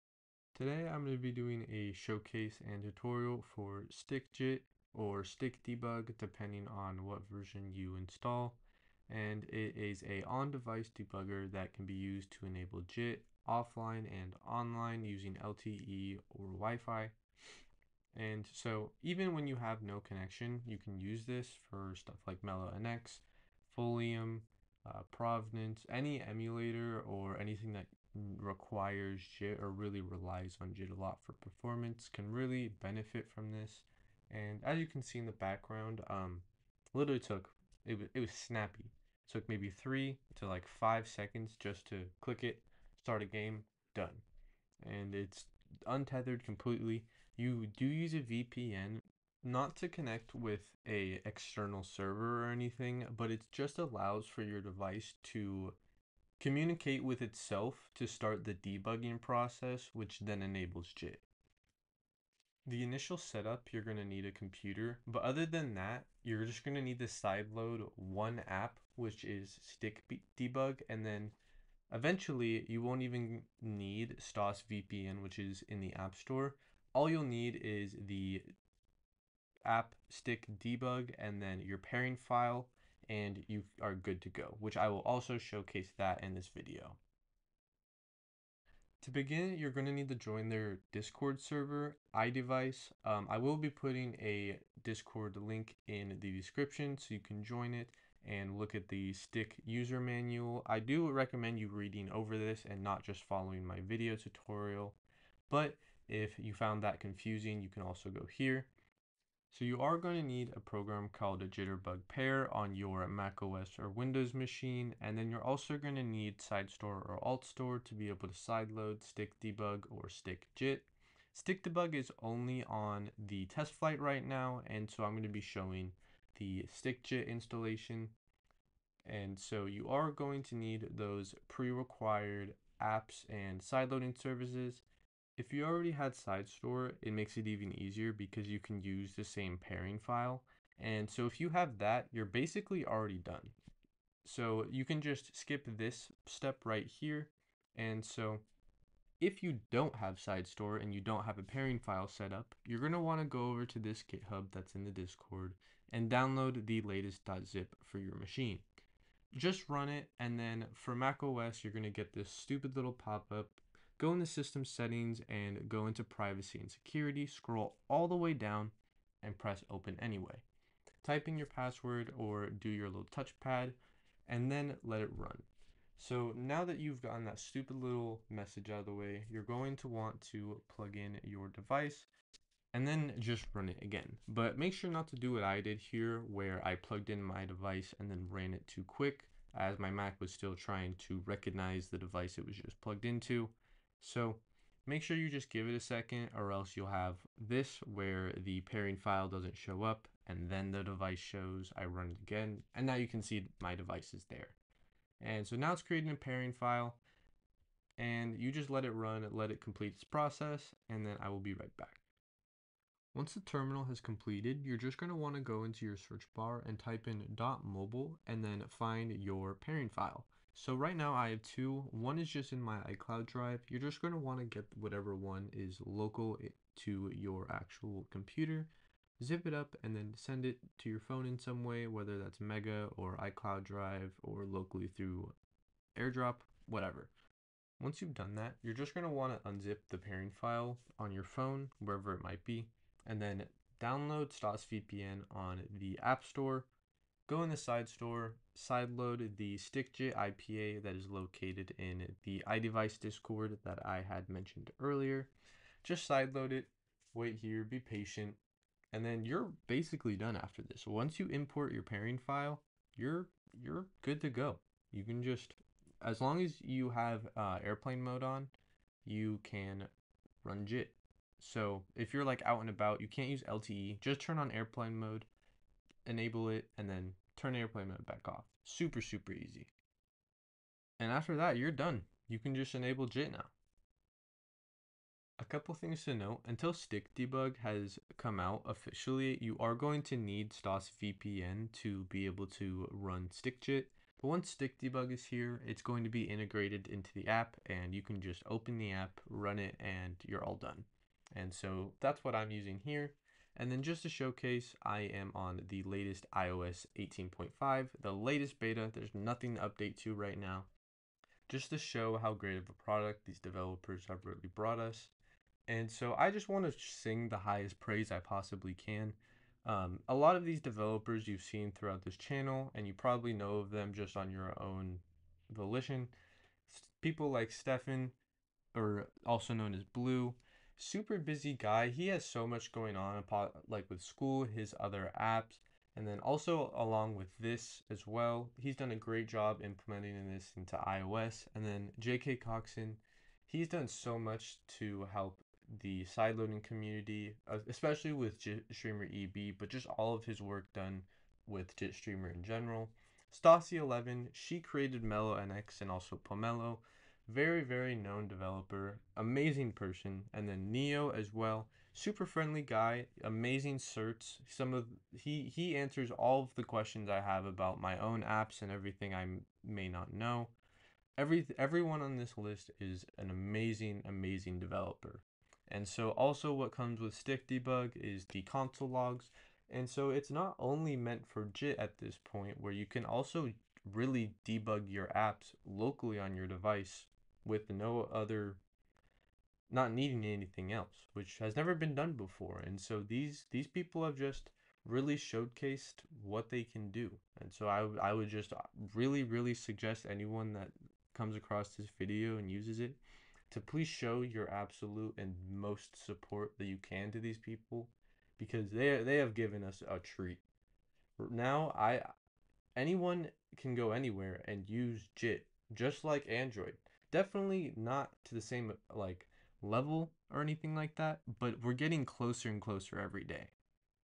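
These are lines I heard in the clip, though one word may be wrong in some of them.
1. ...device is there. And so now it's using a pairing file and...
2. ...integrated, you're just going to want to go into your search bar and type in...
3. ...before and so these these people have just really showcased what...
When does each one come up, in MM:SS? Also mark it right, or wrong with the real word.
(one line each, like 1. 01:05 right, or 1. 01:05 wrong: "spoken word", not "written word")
1. 03:23 wrong: "creating", not "using"
2. 03:33 wrong: "completed", not "integrated"
3. 06:32 right.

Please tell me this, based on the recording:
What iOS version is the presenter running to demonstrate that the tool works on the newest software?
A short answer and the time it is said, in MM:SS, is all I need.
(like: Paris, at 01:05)
iOS 18.5, at 05:06.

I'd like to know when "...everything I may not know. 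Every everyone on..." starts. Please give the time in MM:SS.
06:08.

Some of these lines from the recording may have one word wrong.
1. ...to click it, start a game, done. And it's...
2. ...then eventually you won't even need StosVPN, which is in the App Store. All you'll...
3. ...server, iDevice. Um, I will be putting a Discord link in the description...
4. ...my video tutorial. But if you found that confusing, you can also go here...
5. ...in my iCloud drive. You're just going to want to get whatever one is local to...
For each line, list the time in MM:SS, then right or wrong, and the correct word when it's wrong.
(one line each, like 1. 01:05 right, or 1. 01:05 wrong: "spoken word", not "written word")
1. 00:41 right
2. 01:11 right
3. 01:31 right
4. 01:43 right
5. 03:42 right.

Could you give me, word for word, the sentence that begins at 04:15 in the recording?
Just sideload it, wait here, be patient, and then you're basically done after this.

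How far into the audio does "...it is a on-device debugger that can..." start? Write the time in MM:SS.
00:09.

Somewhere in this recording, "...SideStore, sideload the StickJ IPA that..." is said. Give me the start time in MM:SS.
04:07.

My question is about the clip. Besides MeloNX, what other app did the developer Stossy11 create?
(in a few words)
Pomelo.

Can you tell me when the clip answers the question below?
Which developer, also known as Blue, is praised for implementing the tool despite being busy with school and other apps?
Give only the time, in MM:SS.
05:27.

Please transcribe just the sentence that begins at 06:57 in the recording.
Definitely not to the same like level or anything like that, but we're getting closer and closer every day.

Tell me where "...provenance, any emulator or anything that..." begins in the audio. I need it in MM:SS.
00:25.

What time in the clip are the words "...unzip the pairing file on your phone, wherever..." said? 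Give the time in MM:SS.
03:59.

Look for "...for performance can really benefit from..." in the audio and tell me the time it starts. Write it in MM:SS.
00:31.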